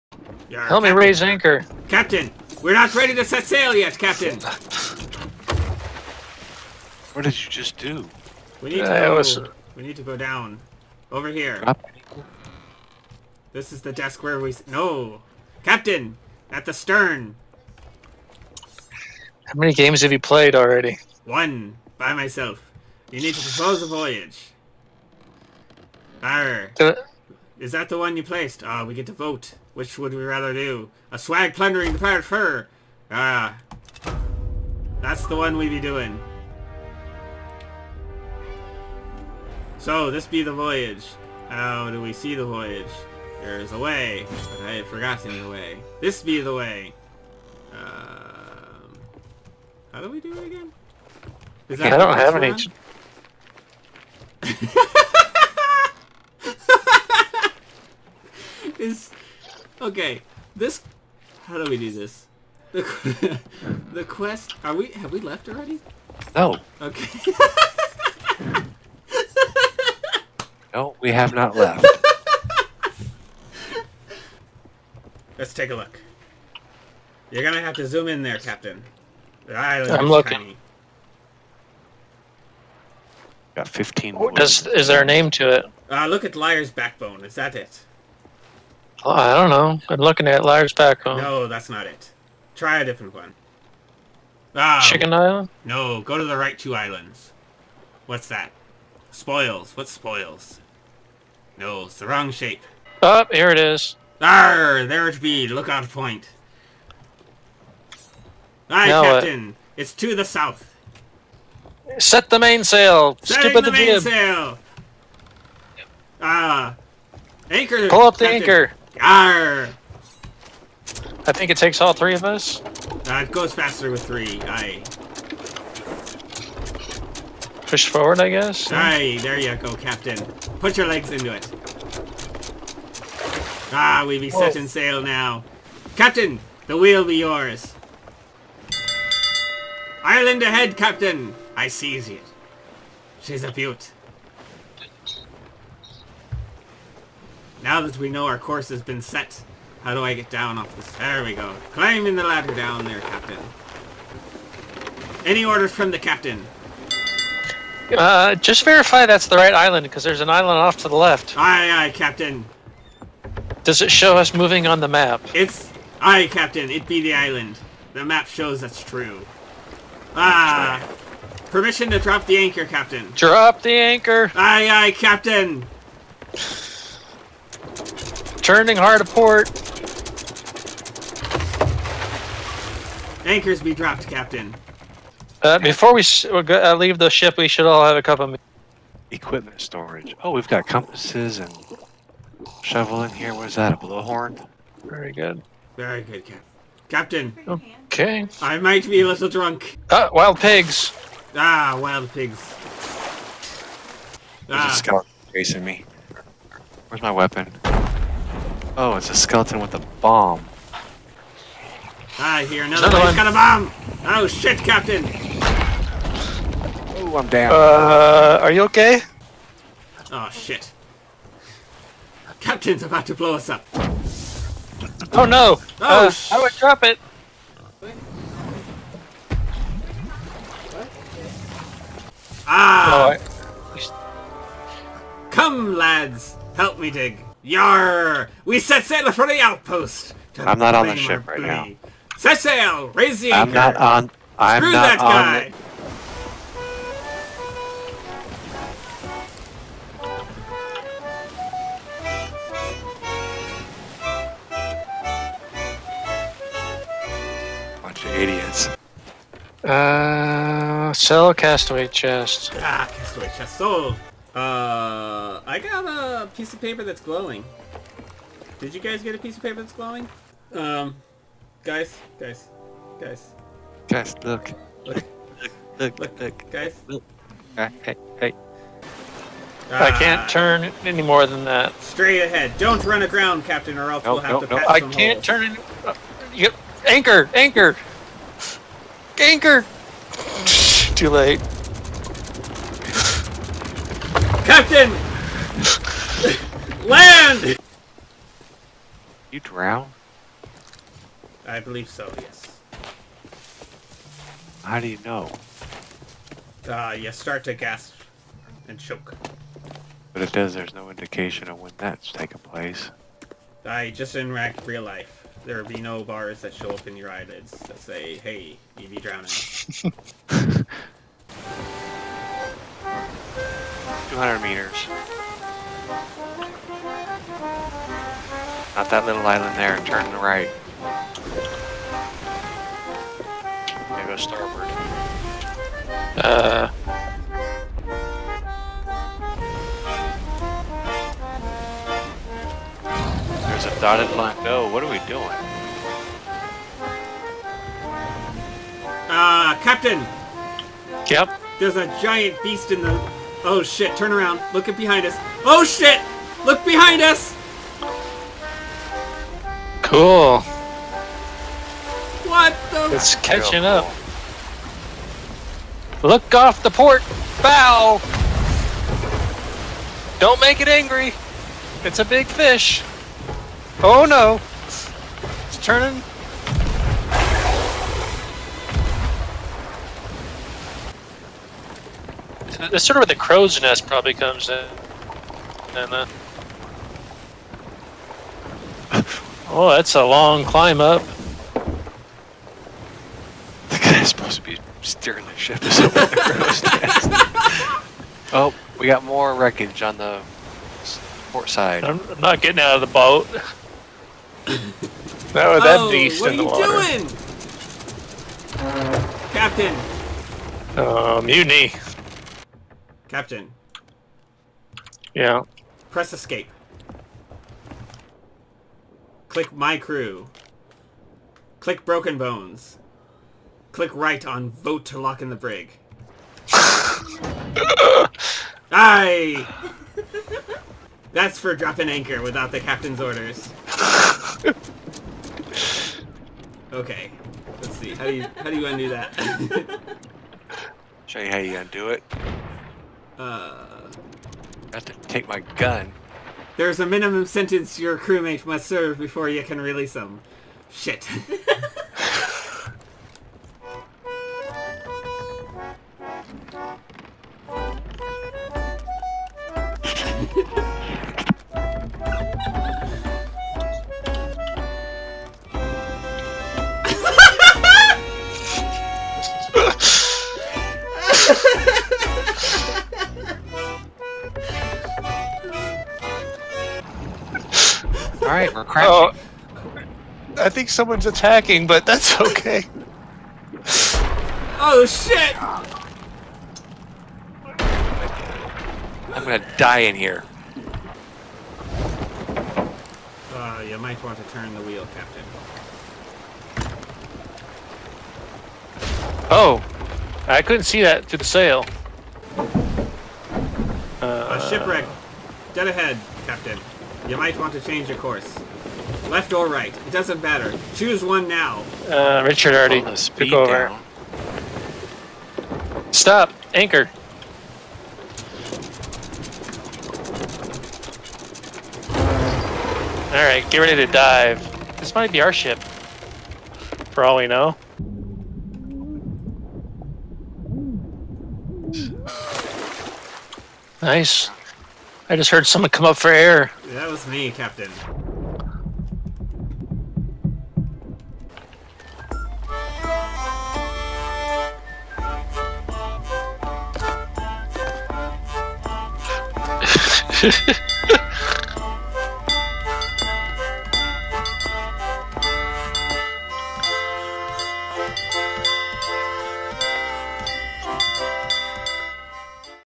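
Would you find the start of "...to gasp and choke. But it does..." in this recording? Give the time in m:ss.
5:07.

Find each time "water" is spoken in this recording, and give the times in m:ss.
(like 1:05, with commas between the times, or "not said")
6:46.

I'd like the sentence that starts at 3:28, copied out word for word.
Oh, it's a skeleton with a bomb.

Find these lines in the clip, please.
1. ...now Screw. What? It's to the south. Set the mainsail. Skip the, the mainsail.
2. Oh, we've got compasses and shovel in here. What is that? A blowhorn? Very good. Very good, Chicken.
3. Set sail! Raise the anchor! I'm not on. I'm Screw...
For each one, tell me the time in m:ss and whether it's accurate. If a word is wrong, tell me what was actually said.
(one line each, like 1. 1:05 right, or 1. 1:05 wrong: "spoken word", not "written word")
1. 1:48 wrong: "Captain", not "Screw"
2. 3:10 wrong: "Captain", not "Chicken"
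3. 4:02 right.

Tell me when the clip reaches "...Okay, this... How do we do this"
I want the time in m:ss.
0:59.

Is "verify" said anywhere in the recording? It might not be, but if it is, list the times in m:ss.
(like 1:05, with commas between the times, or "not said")
2:38.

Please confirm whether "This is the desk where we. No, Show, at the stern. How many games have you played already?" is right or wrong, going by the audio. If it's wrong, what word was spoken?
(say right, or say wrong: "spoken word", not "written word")
wrong: "Captain", not "Show".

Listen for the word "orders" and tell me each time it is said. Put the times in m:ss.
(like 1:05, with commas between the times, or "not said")
2:35, 7:13.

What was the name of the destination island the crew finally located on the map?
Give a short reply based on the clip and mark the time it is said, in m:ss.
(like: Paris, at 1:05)
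Lookout point, at 1:45.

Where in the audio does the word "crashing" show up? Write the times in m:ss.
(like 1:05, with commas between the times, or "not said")
7:58.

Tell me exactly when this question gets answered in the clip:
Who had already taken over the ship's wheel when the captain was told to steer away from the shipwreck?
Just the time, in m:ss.
8:32.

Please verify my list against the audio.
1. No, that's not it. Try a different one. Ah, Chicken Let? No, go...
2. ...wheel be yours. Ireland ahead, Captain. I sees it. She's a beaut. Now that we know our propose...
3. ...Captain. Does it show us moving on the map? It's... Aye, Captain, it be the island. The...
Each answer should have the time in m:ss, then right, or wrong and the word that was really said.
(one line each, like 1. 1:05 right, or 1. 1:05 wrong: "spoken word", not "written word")
1. 1:31 wrong: "Island", not "Let"
2. 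2:16 wrong: "course", not "propose"
3. 2:41 right.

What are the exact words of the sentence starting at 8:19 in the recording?
Oh, I couldn't see that through the sail.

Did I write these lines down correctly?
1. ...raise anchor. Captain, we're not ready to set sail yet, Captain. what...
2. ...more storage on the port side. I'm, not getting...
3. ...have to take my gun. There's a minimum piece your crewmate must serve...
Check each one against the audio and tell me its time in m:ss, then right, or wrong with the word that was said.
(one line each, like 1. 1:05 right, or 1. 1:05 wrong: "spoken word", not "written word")
1. 0:00 right
2. 6:39 wrong: "wreckage", not "storage"
3. 7:24 wrong: "sentence", not "piece".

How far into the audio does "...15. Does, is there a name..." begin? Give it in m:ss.
1:23.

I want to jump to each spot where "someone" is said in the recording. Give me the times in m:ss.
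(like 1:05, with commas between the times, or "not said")
8:00, 8:55.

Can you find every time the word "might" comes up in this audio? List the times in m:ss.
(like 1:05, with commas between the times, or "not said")
3:18, 8:13, 8:27, 8:44.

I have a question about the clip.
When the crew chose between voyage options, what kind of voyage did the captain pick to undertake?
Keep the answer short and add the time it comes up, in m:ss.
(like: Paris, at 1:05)
Plundering the pirate fur, at 0:31.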